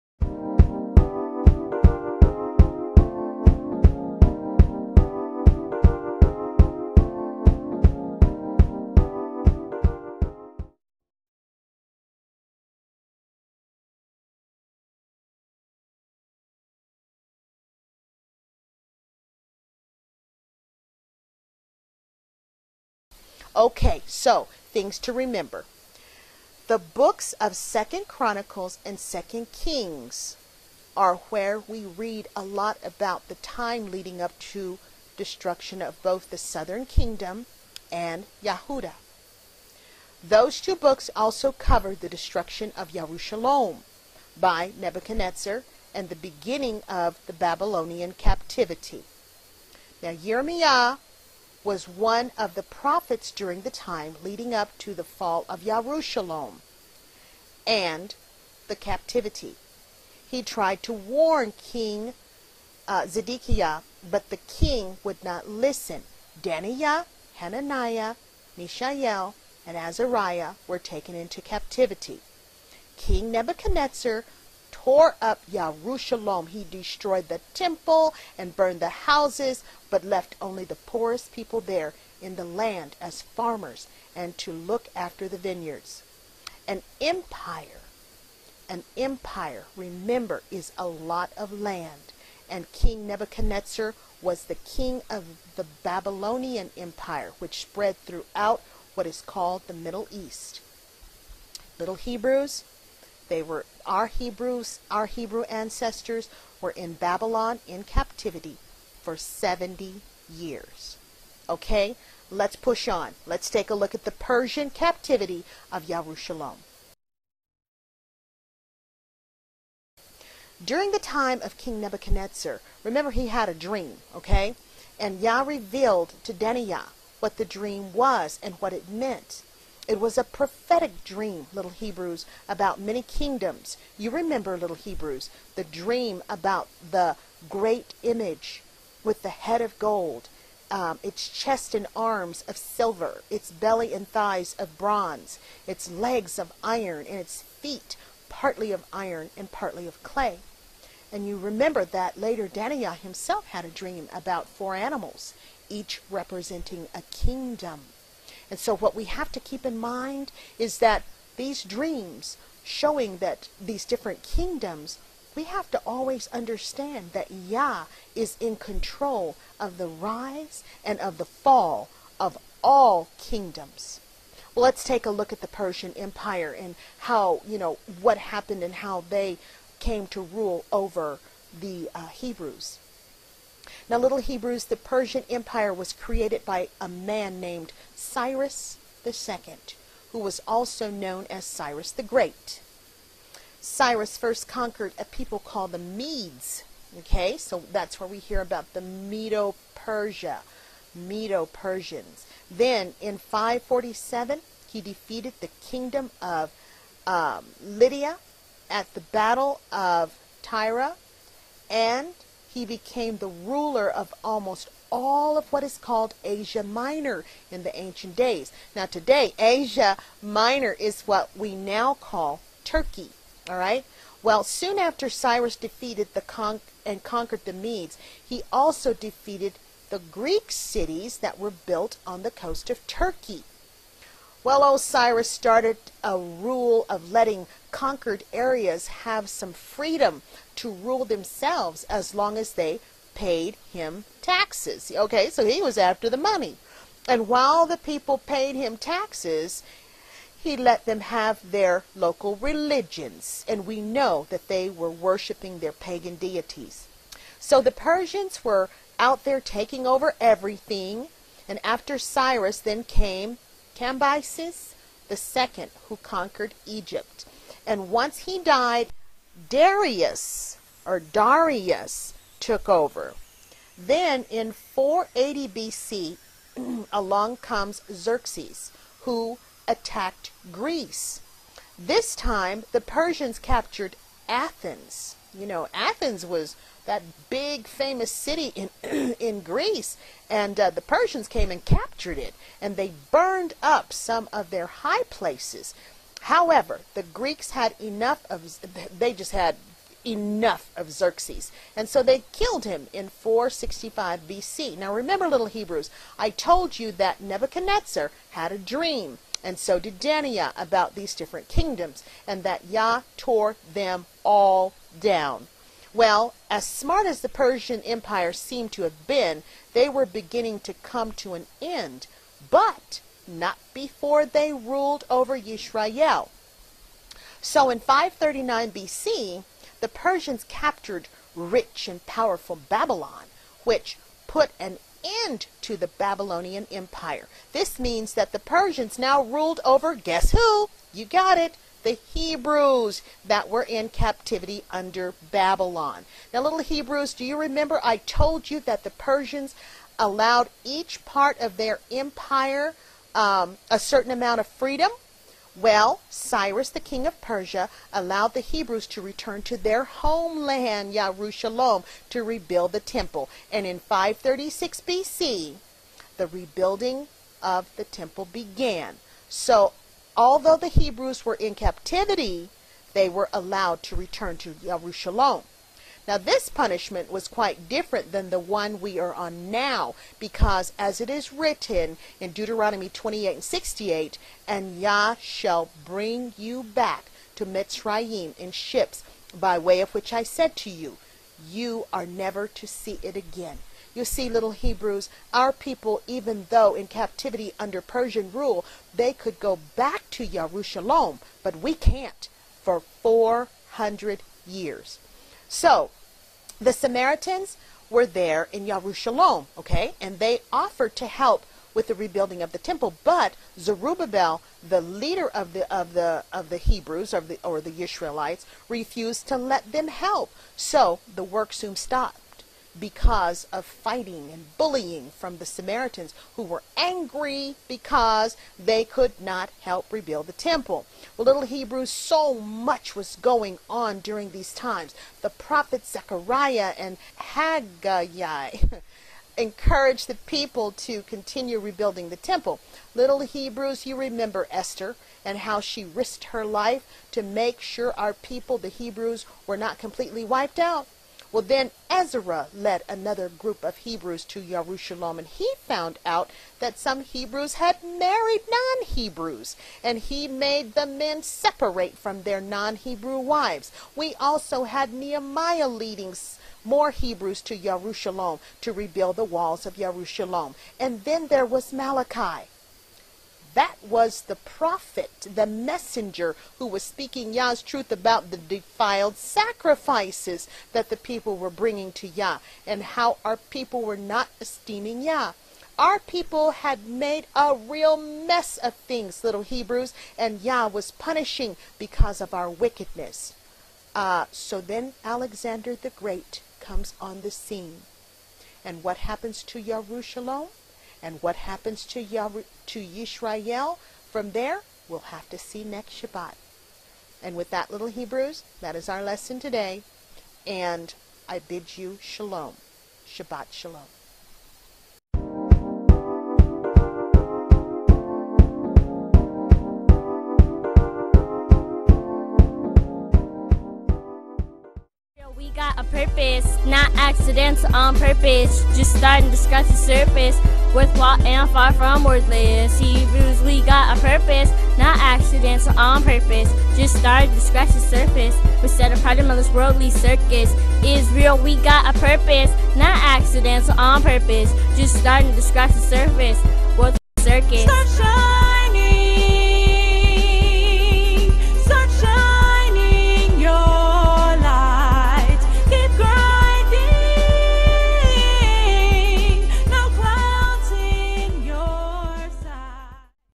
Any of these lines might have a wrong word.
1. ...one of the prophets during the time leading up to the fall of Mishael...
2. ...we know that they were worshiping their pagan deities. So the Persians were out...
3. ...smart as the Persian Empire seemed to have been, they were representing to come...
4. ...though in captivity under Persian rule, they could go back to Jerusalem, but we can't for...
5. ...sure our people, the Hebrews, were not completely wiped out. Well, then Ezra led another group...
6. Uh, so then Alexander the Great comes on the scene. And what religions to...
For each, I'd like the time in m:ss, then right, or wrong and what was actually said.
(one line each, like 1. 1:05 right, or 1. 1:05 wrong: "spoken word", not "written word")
1. 0:51 wrong: "Jerusalem", not "Mishael"
2. 4:13 right
3. 5:16 wrong: "beginning", not "representing"
4. 6:36 right
5. 7:27 right
6. 8:13 wrong: "happens", not "religions".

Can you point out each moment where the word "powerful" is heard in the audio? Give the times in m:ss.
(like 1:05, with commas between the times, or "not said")
5:32.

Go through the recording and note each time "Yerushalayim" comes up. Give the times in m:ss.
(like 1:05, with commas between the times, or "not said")
0:42, 1:55, 6:00, 8:19.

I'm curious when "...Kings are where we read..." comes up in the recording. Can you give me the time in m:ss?
0:29.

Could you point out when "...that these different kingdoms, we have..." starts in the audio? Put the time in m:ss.
2:43.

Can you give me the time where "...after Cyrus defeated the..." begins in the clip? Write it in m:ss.
3:44.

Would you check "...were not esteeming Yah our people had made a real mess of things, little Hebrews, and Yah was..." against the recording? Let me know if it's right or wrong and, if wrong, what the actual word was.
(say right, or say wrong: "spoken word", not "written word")
right.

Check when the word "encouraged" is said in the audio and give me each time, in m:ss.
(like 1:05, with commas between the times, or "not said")
7:19.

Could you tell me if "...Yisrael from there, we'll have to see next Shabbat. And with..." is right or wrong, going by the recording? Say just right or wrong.
right.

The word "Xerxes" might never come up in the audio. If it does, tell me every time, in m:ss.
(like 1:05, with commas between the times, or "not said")
4:37, 5:00.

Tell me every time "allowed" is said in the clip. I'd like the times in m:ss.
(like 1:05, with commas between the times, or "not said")
5:49, 5:57, 6:13.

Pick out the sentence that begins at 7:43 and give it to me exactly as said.
We also had Nehemiah leading more Hebrews to Jerusalem to rebuild the walls of Jerusalem.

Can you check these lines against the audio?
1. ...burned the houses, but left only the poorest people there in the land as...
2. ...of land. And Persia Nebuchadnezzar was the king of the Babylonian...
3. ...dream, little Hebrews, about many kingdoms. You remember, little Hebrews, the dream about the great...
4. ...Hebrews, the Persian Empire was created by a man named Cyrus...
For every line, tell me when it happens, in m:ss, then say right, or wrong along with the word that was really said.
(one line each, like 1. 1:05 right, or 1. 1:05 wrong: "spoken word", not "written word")
1. 1:18 right
2. 1:31 wrong: "King", not "Persia"
3. 2:11 right
4. 3:04 right.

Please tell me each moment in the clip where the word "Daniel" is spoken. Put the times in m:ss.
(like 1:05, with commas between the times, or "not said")
1:06, 2:06, 2:32, 5:10.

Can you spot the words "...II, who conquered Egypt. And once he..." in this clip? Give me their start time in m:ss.
4:25.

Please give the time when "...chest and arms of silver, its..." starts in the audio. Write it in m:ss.
2:21.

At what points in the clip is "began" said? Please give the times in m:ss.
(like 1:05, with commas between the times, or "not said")
6:08.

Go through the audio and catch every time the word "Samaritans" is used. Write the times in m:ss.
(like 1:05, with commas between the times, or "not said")
6:46, 7:05.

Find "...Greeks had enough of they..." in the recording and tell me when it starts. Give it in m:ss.
4:57.